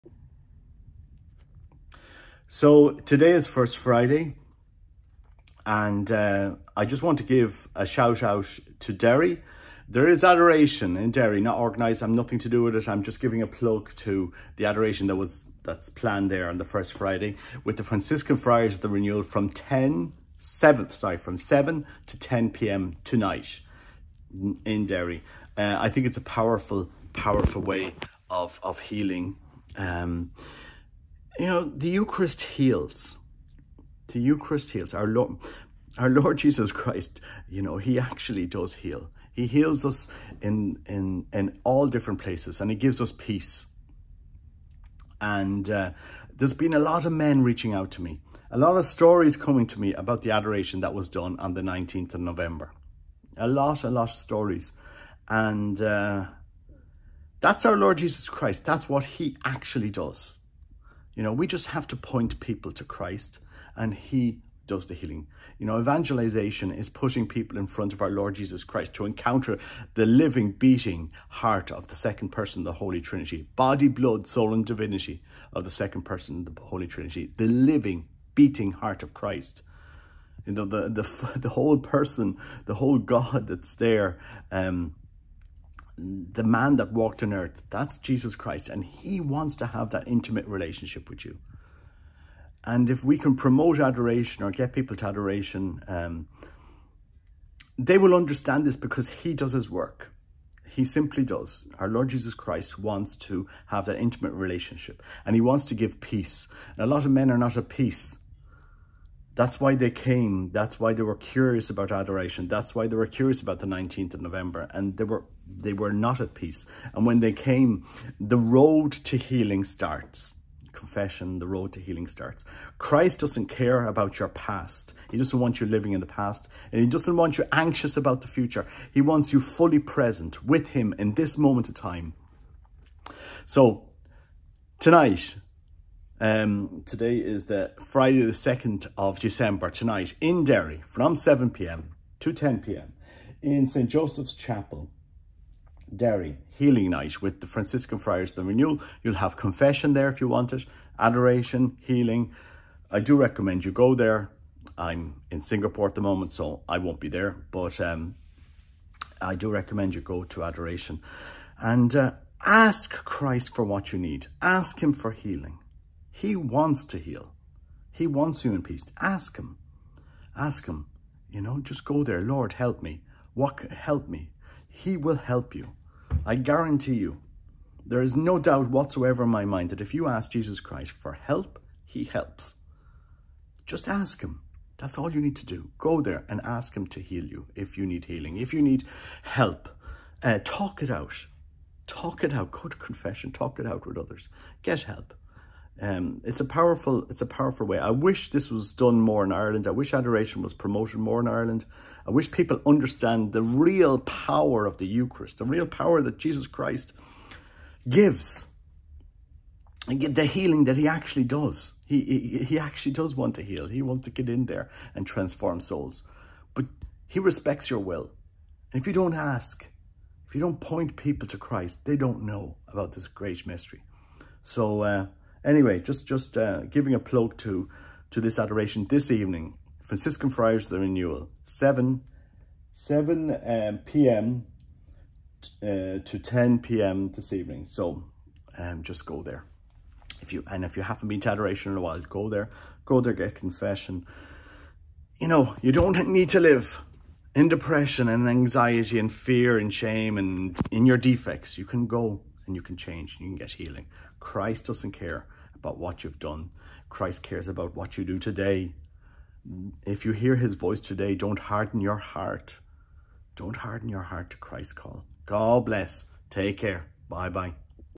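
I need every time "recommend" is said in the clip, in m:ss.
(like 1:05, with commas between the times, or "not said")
2:33, 2:39.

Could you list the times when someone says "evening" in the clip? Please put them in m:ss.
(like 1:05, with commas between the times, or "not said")
3:49, 3:57.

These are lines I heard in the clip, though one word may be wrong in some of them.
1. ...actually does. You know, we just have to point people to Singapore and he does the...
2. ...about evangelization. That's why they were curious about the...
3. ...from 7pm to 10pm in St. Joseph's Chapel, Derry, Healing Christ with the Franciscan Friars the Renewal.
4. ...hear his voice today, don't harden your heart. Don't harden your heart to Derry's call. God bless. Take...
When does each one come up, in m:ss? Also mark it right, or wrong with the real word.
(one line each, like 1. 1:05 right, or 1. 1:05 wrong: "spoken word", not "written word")
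1. 0:59 wrong: "Christ", not "Singapore"
2. 1:51 wrong: "adoration", not "evangelization"
3. 2:20 wrong: "Night", not "Christ"
4. 4:20 wrong: "Christ", not "Derry".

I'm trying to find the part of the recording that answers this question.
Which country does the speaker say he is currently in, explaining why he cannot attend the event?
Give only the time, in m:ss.
2:35.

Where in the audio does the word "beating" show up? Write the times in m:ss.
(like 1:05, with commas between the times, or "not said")
1:10, 1:18.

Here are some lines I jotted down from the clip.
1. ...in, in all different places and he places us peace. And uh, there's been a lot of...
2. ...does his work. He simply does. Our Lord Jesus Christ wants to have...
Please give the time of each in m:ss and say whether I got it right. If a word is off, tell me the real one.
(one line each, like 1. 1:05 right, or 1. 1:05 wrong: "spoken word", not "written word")
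1. 0:40 wrong: "gives", not "places"
2. 1:39 right.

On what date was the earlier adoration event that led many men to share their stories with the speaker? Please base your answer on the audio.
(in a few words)
19th of November.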